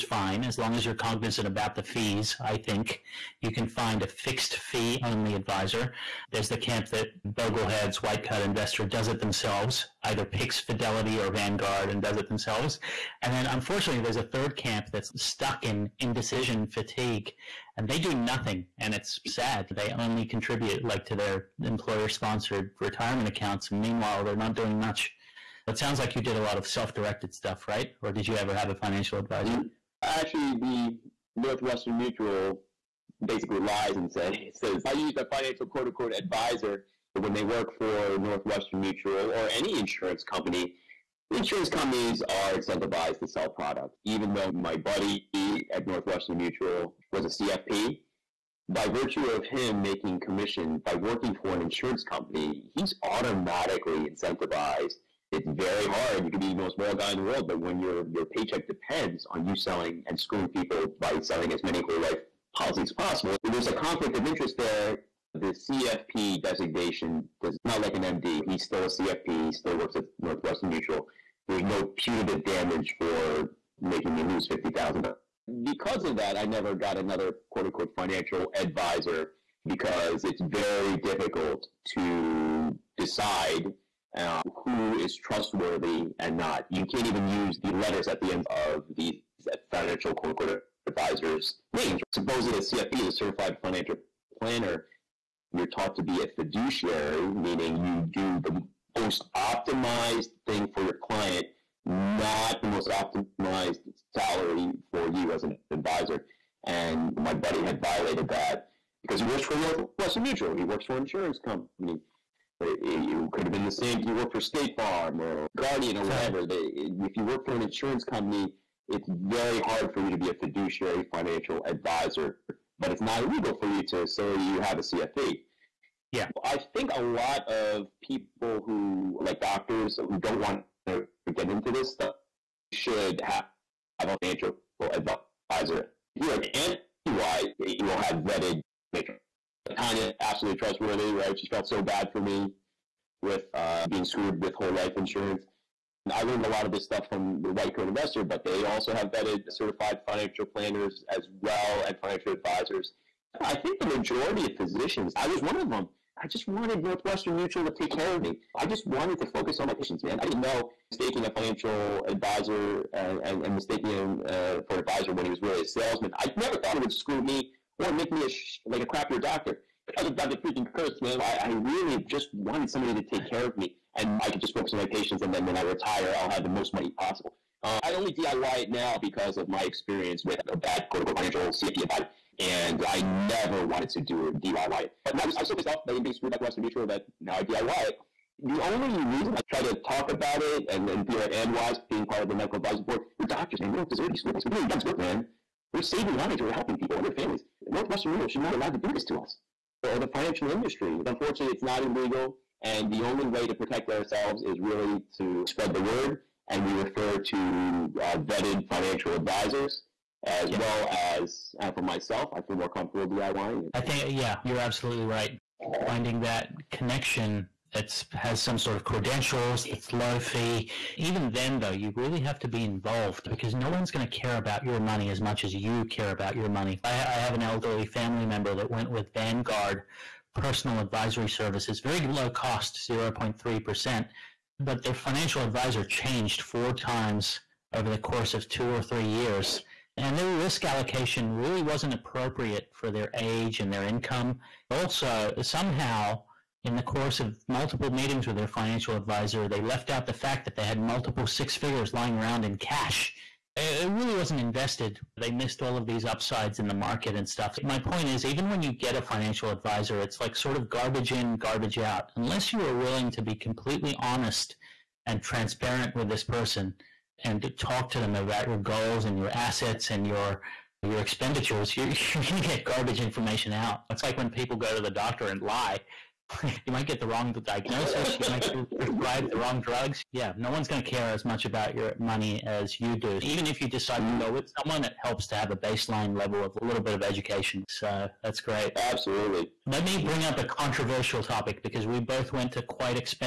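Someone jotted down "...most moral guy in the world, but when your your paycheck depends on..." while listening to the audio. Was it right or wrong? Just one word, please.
right.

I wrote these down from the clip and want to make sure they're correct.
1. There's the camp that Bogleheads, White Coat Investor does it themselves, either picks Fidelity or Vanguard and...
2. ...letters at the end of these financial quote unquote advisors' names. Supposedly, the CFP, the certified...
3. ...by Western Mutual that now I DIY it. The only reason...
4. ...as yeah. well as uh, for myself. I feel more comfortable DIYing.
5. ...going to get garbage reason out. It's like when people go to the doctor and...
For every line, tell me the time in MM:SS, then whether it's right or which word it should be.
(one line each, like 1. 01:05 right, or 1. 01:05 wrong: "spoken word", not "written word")
1. 00:06 right
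2. 01:27 right
3. 03:06 right
4. 03:30 right
5. 04:32 wrong: "information", not "reason".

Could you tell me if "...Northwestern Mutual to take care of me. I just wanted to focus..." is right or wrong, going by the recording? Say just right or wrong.
right.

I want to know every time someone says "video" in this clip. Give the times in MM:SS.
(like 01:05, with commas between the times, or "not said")
not said.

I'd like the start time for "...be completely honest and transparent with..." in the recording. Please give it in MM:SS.
04:23.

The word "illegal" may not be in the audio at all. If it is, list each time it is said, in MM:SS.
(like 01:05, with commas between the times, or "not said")
02:03, 03:21.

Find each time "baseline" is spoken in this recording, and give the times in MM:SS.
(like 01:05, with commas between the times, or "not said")
04:45.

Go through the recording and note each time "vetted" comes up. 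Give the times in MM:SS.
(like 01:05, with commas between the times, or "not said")
02:18, 02:29, 03:28.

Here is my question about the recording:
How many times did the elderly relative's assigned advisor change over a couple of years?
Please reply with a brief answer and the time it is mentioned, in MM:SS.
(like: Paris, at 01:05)
4 times, at 03:56.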